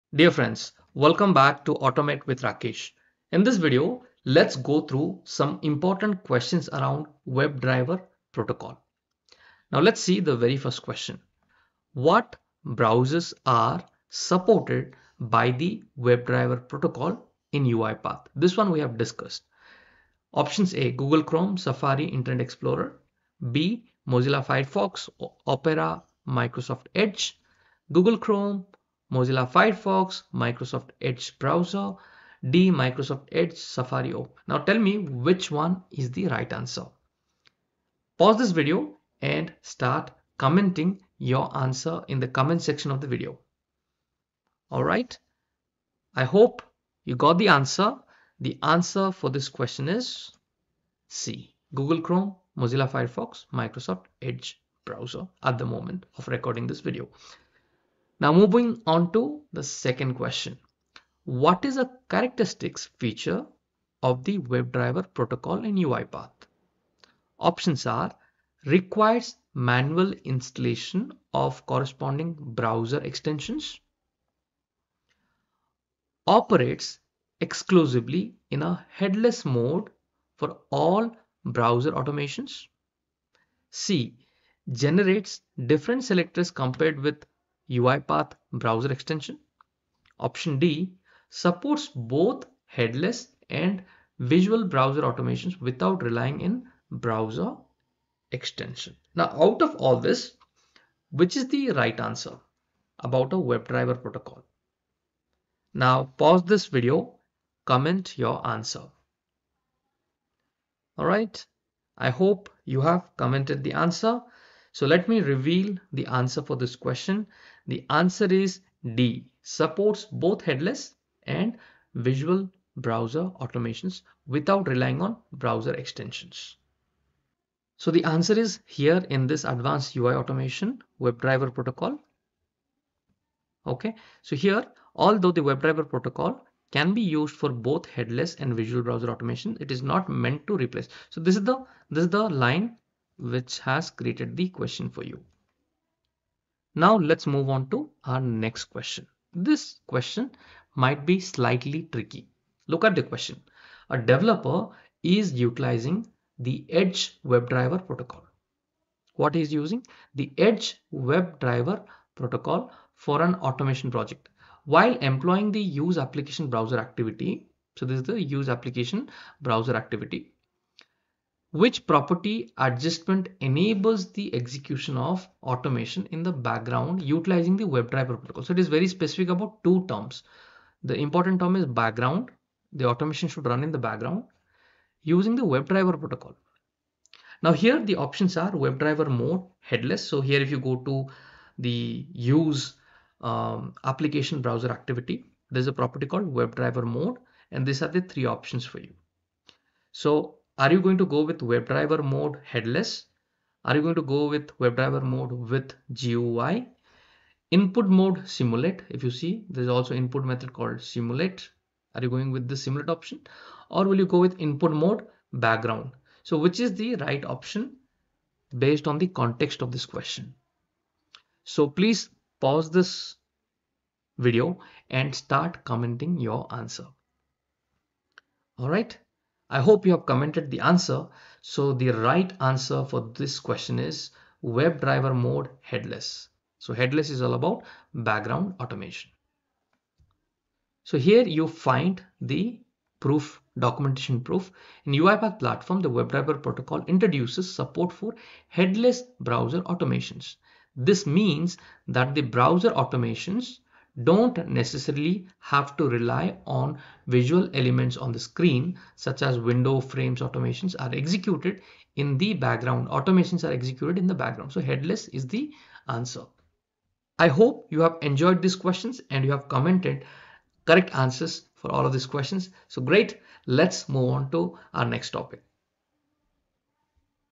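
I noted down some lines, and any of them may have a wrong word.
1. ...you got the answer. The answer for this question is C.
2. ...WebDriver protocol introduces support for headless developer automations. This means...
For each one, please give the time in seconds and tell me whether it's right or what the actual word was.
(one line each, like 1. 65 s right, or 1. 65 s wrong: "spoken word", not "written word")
1. 47 s right
2. 245 s wrong: "browser", not "developer".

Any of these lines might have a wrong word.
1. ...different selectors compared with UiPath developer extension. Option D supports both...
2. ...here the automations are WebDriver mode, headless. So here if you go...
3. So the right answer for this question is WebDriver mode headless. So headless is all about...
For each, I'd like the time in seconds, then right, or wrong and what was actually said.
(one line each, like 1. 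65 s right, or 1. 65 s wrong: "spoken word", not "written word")
1. 85 s wrong: "browser", not "developer"
2. 187 s wrong: "options", not "automations"
3. 231 s right.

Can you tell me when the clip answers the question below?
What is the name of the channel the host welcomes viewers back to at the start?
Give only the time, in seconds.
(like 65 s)
1 s.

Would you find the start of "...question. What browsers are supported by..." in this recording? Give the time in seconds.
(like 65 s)
10 s.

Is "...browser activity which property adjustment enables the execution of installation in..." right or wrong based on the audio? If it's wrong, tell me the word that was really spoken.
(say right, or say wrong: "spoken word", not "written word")
wrong: "automation", not "installation".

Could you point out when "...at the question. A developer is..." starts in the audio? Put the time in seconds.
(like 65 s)
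152 s.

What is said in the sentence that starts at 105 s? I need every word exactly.
Now pause this video, comment your answer.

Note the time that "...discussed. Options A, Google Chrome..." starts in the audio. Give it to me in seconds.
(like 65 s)
18 s.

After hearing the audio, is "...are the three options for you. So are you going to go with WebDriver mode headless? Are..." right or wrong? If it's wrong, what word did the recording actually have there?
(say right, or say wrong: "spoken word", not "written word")
right.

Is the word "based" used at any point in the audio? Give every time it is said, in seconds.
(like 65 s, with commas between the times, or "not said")
218 s.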